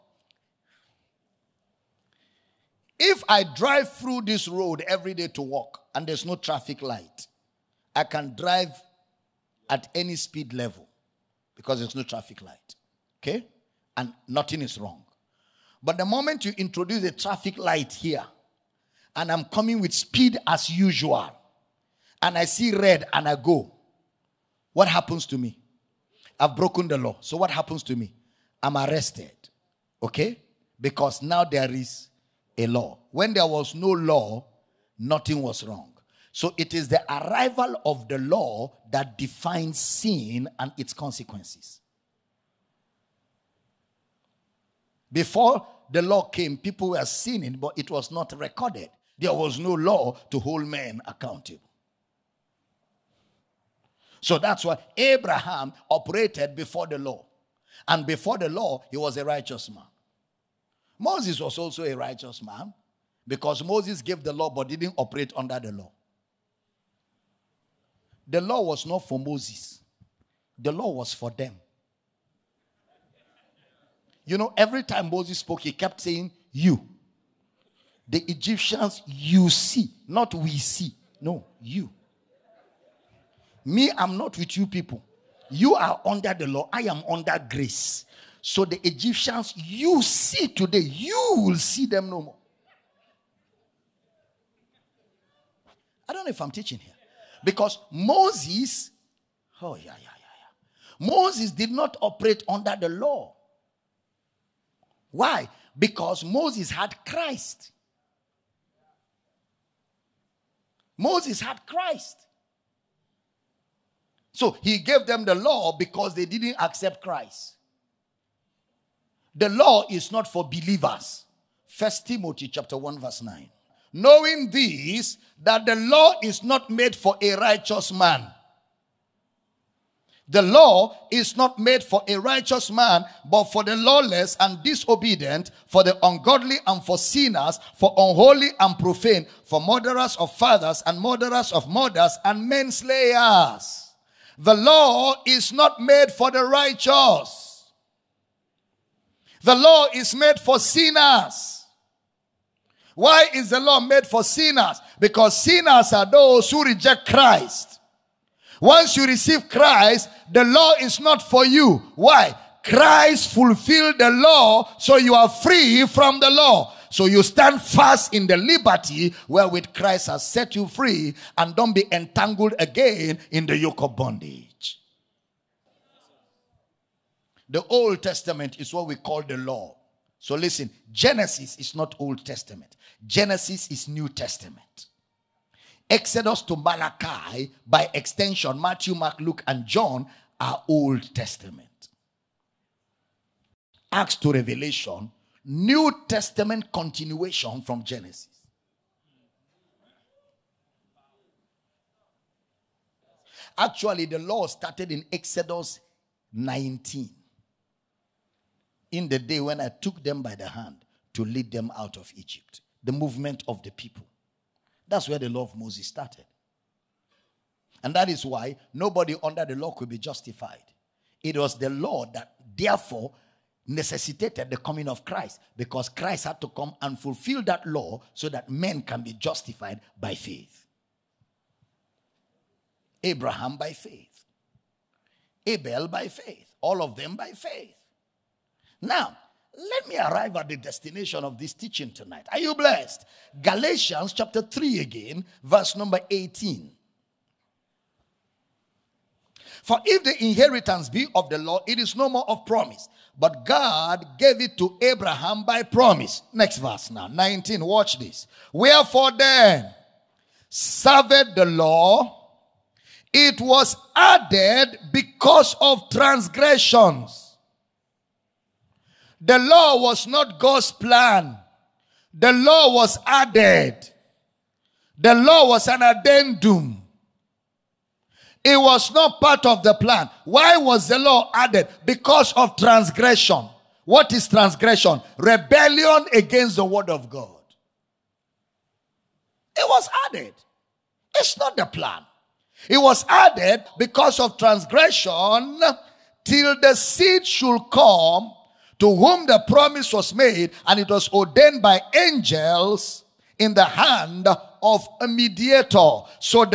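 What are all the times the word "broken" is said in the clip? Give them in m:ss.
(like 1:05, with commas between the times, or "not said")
0:26.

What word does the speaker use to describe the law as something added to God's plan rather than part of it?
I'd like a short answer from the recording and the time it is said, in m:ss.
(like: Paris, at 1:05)
addendum, at 4:35.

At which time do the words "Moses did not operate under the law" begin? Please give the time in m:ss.
1:41.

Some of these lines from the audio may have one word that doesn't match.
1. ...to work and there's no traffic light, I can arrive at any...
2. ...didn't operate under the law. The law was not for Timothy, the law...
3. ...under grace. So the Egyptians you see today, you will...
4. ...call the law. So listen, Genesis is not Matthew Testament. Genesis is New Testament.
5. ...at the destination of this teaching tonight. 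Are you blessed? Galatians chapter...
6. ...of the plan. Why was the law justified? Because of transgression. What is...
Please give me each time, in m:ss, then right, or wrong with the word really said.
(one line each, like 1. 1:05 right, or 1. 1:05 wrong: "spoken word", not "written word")
1. 0:05 wrong: "drive", not "arrive"
2. 1:04 wrong: "Moses", not "Timothy"
3. 1:27 right
4. 2:58 wrong: "Old", not "Matthew"
5. 4:00 right
6. 4:39 wrong: "added", not "justified".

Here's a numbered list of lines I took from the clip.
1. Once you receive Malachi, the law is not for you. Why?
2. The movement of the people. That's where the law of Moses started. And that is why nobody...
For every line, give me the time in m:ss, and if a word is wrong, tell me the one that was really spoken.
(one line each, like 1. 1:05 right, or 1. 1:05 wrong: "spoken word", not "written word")
1. 2:38 wrong: "Christ", not "Malachi"
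2. 3:32 right.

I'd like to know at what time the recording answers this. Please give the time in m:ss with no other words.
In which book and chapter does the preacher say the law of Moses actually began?
3:25.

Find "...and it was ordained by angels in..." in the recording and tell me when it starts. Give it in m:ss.
5:00.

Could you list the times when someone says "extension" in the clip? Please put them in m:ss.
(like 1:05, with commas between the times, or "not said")
3:07.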